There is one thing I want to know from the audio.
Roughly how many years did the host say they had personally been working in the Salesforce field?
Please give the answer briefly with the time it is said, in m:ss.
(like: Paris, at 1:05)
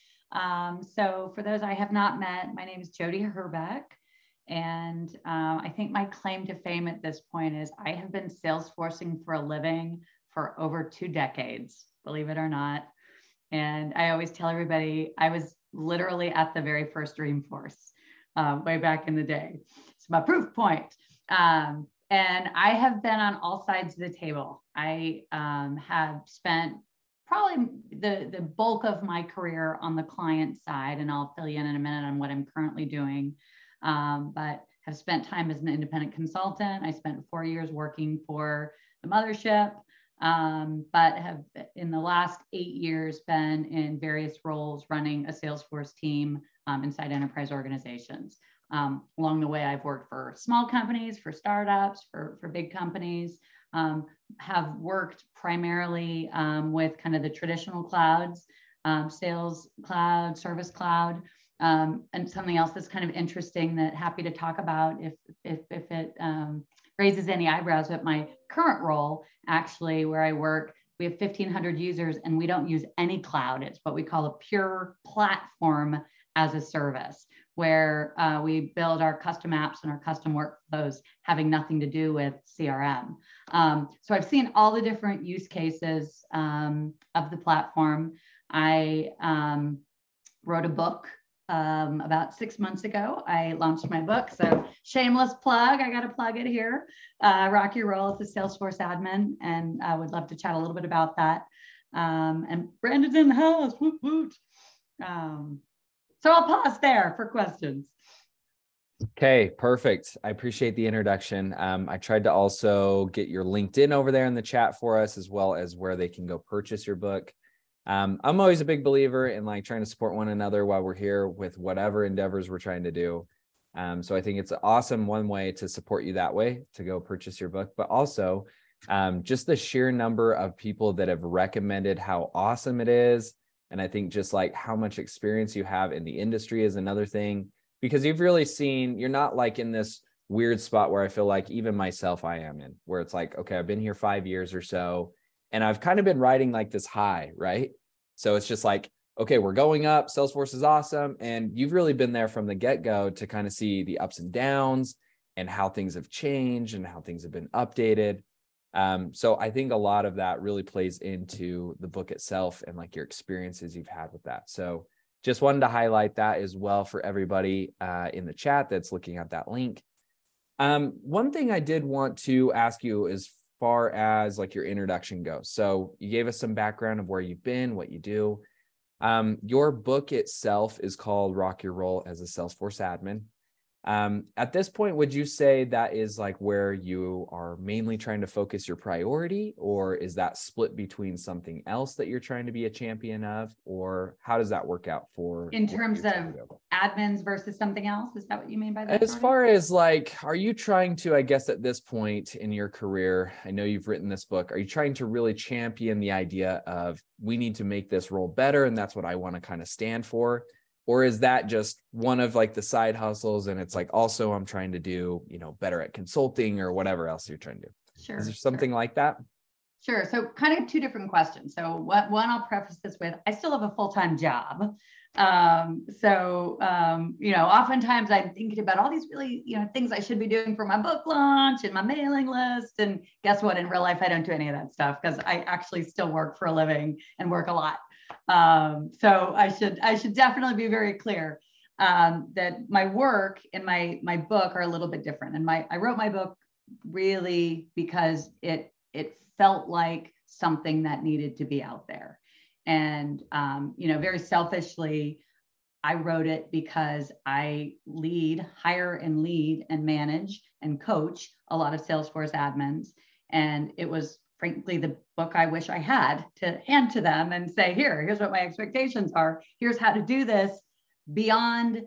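5 years, at 2:23.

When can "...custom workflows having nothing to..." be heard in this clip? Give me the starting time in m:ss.
1:20.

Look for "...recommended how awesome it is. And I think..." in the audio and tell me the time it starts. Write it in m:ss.
2:11.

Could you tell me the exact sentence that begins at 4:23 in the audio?
And it was frankly the book I wish I had to hand to them and say, here, here's what my expectations are.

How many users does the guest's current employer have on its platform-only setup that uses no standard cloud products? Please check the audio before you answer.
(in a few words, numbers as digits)
1500.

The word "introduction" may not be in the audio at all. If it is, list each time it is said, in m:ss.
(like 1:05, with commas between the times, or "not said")
1:50, 2:54.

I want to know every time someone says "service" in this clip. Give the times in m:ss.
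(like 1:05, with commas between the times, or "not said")
1:00, 1:16.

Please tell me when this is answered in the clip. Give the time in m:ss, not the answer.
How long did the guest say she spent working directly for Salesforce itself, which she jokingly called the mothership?
0:37.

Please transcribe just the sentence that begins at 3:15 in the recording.
In terms of admins versus something else, is that what you mean by that?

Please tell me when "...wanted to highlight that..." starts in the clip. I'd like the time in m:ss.
2:45.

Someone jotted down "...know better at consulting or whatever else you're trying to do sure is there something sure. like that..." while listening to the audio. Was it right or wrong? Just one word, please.
right.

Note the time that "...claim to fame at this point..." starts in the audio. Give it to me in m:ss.
0:06.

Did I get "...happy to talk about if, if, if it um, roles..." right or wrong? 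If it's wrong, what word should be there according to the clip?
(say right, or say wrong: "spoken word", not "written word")
wrong: "raises", not "roles".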